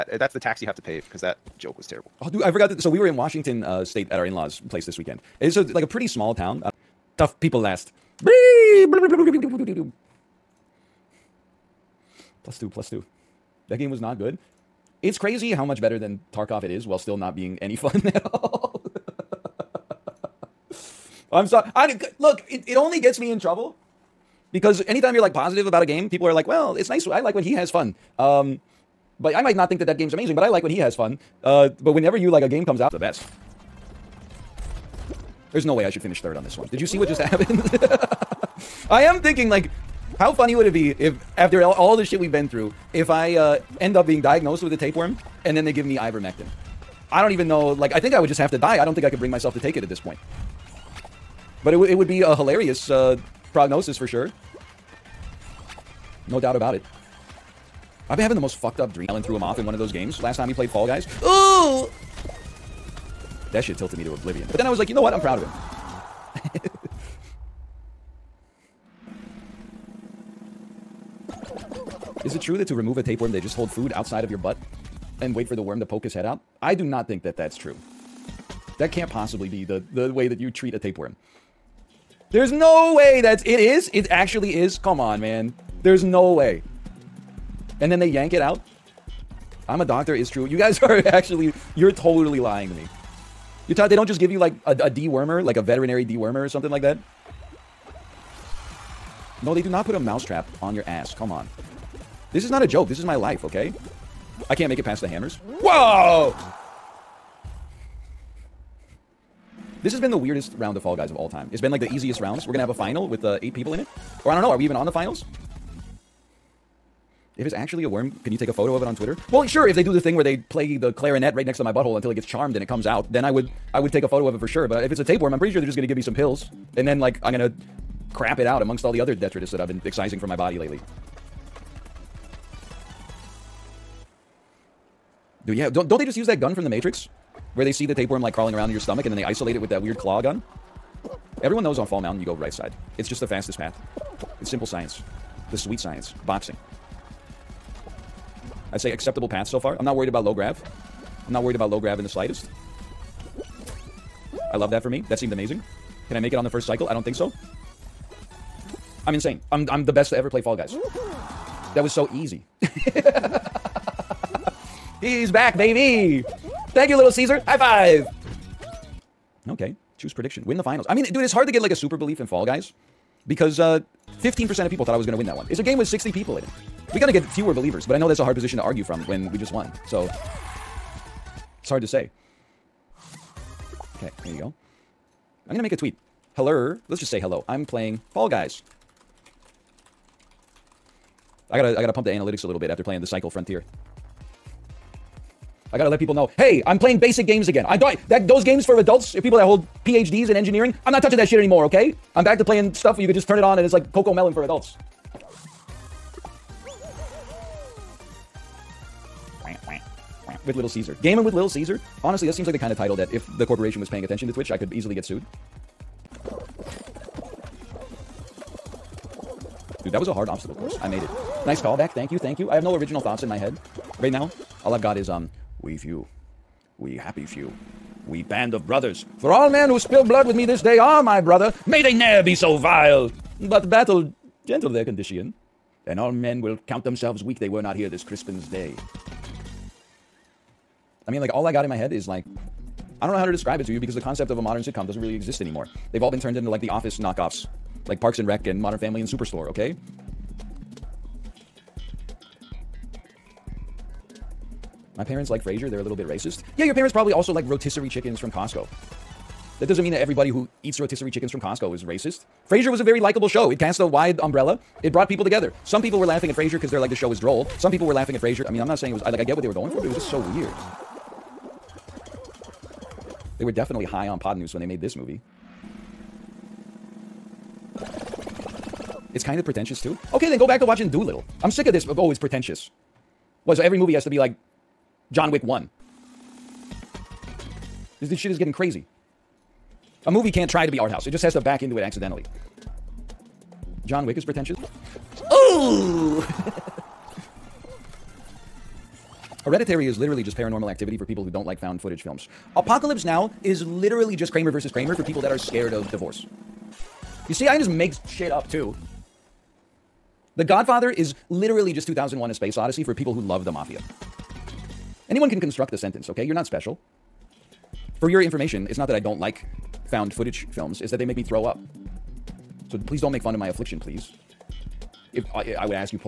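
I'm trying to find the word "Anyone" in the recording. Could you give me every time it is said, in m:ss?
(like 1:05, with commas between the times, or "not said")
5:15.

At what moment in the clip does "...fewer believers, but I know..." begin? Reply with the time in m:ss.
2:57.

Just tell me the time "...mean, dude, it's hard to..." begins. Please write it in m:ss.
2:50.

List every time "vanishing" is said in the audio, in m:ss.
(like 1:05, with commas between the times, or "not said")
not said.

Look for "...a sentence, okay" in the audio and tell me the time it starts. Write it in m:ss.
5:15.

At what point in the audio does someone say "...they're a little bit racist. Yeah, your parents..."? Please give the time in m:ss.
4:15.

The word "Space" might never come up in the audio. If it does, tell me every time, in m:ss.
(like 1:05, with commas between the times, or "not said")
5:12.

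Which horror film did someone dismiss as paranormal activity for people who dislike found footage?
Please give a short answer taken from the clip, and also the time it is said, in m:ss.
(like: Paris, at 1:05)
Hereditary, at 4:59.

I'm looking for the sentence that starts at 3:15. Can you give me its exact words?
I gotta let people know, hey, I'm playing basic games again.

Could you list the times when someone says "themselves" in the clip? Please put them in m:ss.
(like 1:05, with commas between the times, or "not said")
3:56.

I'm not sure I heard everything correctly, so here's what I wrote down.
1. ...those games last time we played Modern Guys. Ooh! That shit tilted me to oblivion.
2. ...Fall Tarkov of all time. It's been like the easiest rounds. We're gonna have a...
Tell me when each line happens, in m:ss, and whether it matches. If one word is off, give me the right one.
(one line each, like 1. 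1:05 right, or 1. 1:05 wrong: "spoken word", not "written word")
1. 0:59 wrong: "Fall", not "Modern"
2. 1:50 wrong: "Guys", not "Tarkov".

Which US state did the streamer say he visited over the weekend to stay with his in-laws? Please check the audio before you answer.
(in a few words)
Washington.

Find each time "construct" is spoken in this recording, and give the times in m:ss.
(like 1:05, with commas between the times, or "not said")
5:15.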